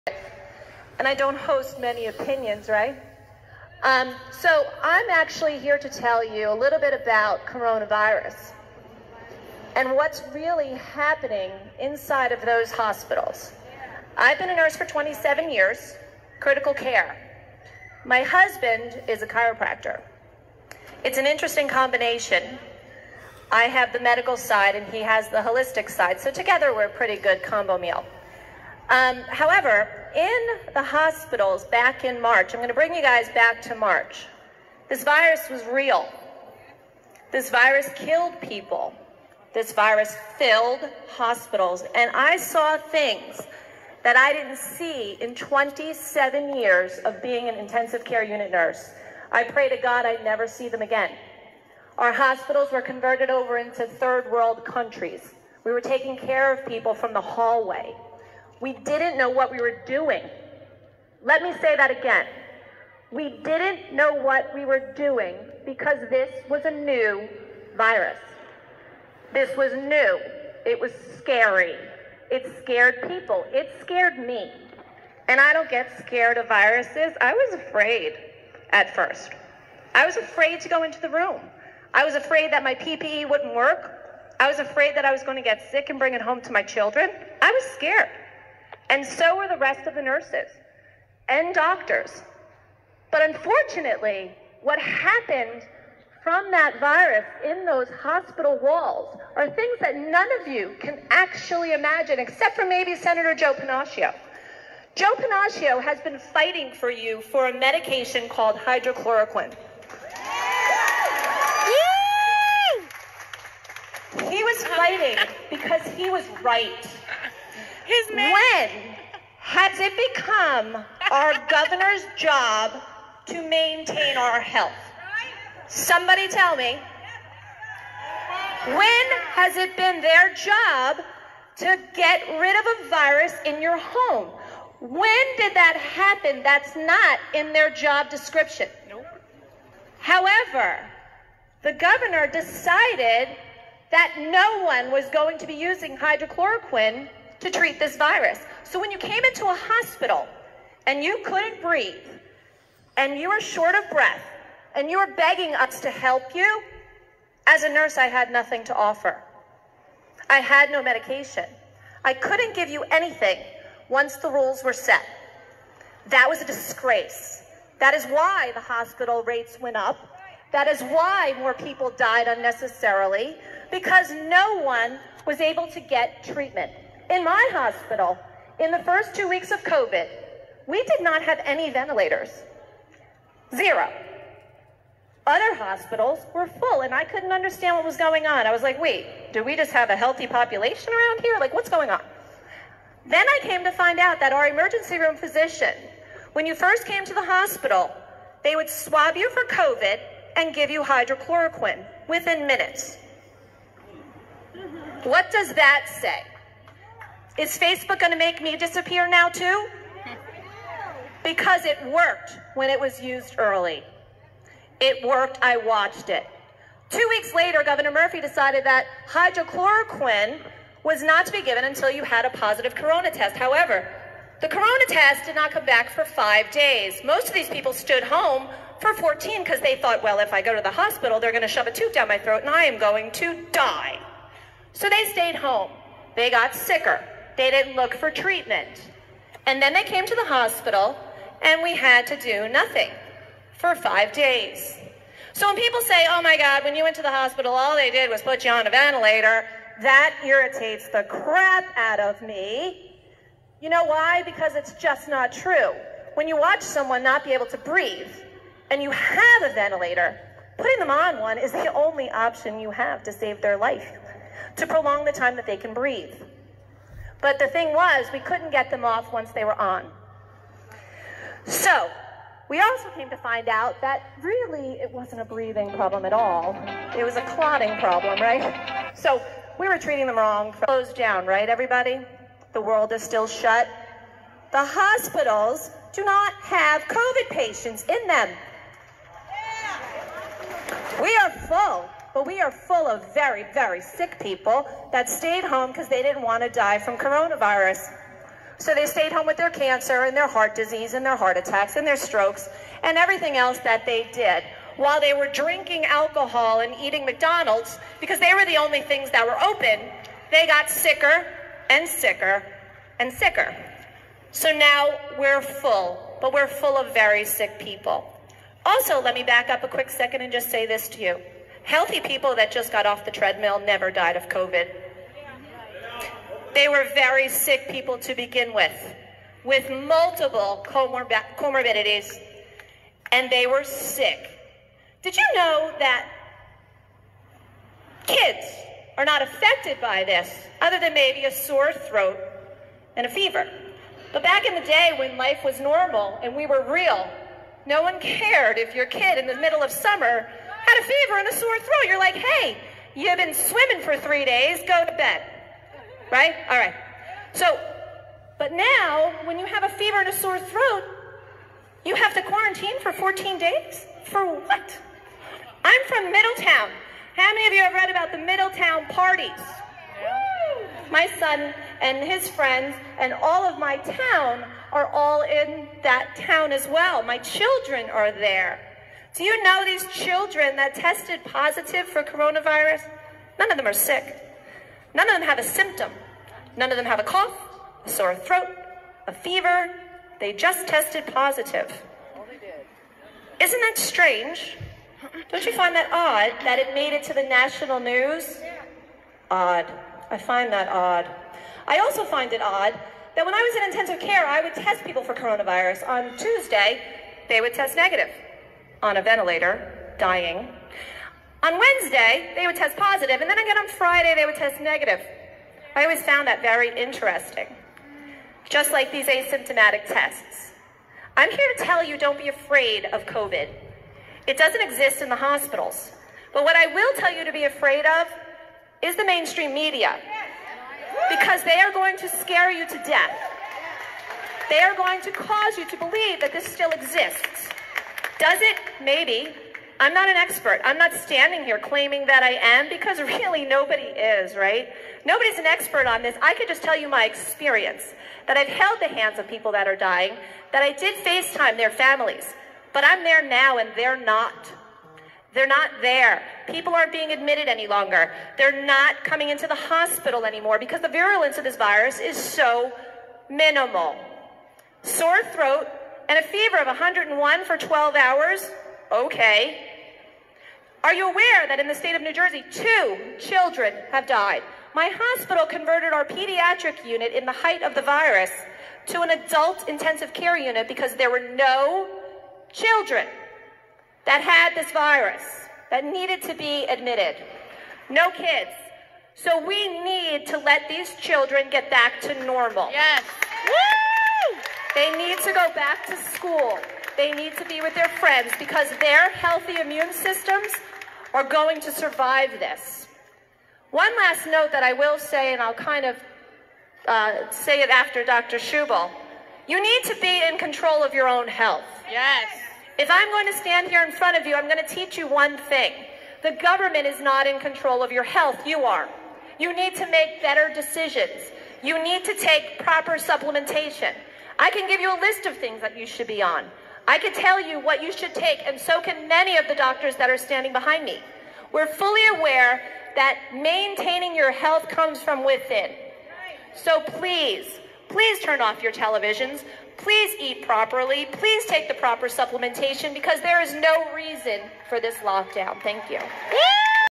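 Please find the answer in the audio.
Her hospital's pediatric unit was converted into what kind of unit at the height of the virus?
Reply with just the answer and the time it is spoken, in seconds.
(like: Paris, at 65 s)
Adult intensive care unit, at 479 s.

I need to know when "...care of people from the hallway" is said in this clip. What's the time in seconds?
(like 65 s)
56 s.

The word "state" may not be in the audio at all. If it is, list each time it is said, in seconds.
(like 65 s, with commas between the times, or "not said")
471 s.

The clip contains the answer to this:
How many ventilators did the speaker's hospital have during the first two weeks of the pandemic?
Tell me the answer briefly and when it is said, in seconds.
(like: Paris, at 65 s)
0, at 183 s.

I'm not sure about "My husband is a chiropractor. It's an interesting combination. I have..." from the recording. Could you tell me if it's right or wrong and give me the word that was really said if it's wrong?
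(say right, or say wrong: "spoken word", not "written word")
right.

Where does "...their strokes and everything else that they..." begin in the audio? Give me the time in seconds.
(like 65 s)
301 s.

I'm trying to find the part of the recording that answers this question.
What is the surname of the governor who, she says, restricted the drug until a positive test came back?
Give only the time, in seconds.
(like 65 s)
217 s.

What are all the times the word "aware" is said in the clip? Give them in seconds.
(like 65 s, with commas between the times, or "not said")
471 s, 532 s.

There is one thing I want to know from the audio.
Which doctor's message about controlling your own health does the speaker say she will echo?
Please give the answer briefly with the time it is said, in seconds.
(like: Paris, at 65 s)
Dr. Schubel, at 508 s.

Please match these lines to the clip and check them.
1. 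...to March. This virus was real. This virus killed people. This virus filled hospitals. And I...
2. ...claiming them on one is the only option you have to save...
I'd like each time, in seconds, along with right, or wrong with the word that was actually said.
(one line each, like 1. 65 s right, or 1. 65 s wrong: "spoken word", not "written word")
1. 33 s right
2. 260 s wrong: "putting", not "claiming".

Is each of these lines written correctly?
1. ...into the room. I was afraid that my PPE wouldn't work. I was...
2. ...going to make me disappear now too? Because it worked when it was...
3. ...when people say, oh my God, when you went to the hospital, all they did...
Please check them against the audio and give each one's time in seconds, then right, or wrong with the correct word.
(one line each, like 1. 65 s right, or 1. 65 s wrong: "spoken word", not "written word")
1. 80 s right
2. 207 s right
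3. 245 s right.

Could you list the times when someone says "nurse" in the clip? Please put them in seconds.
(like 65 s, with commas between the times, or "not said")
14 s, 48 s, 90 s, 157 s.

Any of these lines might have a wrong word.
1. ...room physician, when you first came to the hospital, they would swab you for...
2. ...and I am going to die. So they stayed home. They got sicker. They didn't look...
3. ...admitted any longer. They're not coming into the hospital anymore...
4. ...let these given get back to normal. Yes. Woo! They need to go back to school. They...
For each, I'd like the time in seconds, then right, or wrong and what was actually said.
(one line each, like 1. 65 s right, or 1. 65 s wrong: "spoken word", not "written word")
1. 194 s right
2. 232 s right
3. 457 s right
4. 490 s wrong: "children", not "given".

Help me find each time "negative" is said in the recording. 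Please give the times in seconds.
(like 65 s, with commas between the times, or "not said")
407 s, 414 s.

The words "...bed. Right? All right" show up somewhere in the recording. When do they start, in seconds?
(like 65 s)
354 s.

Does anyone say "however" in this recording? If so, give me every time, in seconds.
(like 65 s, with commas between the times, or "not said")
29 s, 139 s, 223 s.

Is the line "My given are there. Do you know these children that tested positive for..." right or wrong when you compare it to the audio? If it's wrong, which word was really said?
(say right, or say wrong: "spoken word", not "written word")
wrong: "children", not "given".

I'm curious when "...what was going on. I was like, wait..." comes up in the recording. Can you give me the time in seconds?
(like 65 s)
187 s.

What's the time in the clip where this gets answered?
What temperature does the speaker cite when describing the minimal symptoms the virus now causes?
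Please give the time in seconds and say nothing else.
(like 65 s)
466 s.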